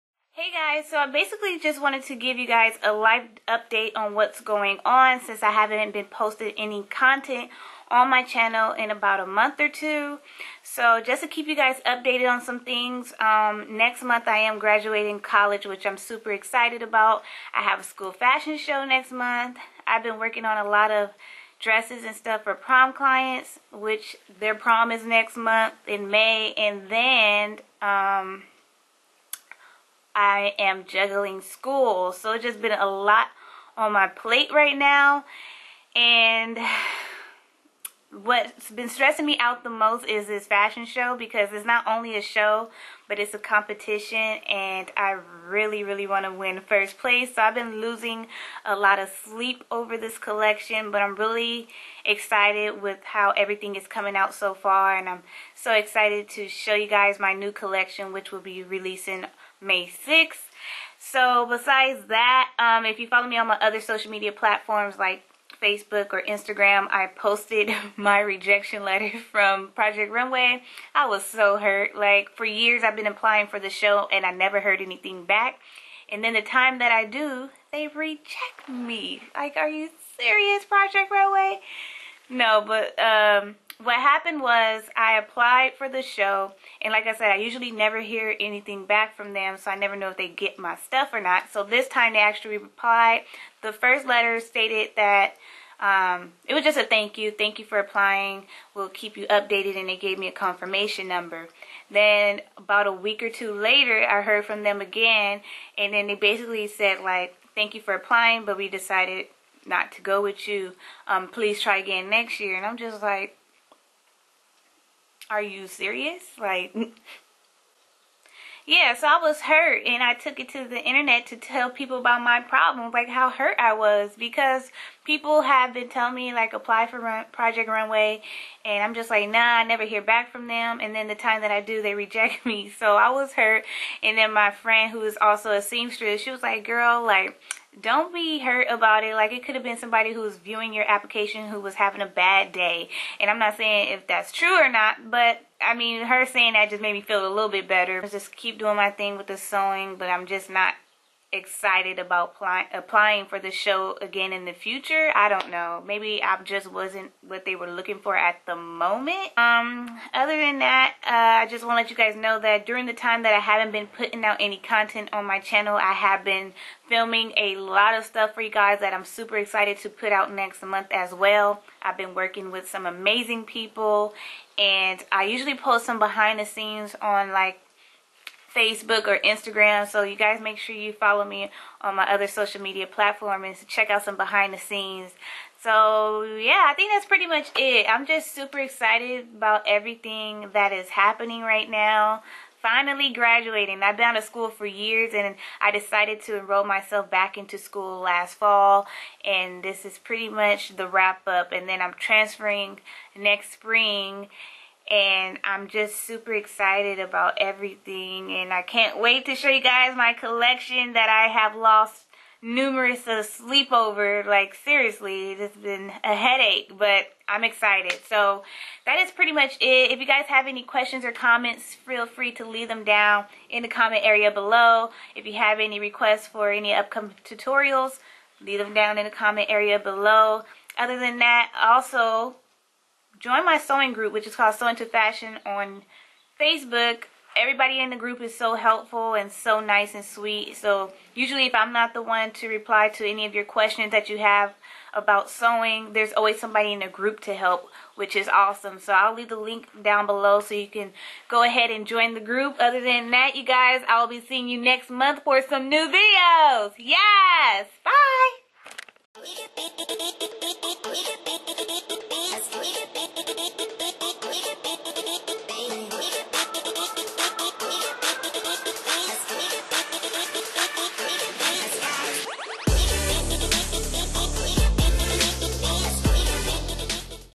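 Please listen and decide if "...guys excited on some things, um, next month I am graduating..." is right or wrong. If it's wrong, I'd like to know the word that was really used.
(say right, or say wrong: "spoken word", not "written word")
wrong: "updated", not "excited".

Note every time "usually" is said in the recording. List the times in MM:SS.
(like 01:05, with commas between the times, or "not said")
01:27, 02:55, 04:01.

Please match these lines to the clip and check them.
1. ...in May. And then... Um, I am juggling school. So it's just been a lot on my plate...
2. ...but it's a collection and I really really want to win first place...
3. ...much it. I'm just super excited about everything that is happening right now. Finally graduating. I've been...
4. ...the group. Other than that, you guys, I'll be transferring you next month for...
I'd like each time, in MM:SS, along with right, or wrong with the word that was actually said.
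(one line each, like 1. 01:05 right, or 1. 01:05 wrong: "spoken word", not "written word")
1. 00:25 right
2. 00:43 wrong: "competition", not "collection"
3. 03:07 right
4. 04:12 wrong: "seeing", not "transferring".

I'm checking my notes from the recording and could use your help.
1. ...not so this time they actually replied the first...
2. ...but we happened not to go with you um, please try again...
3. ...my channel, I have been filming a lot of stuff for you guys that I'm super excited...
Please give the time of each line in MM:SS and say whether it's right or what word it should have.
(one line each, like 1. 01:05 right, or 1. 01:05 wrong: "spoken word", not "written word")
1. 01:31 right
2. 01:48 wrong: "decided", not "happened"
3. 02:45 right.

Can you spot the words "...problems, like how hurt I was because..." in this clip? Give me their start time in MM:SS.
02:02.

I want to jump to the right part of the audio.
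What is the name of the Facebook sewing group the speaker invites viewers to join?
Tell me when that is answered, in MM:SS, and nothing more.
03:54.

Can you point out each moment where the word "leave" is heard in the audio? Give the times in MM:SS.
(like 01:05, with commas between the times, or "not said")
03:42, 03:48, 04:09.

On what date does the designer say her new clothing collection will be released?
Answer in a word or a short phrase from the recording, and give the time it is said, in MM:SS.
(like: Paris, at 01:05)
May 6th, at 00:59.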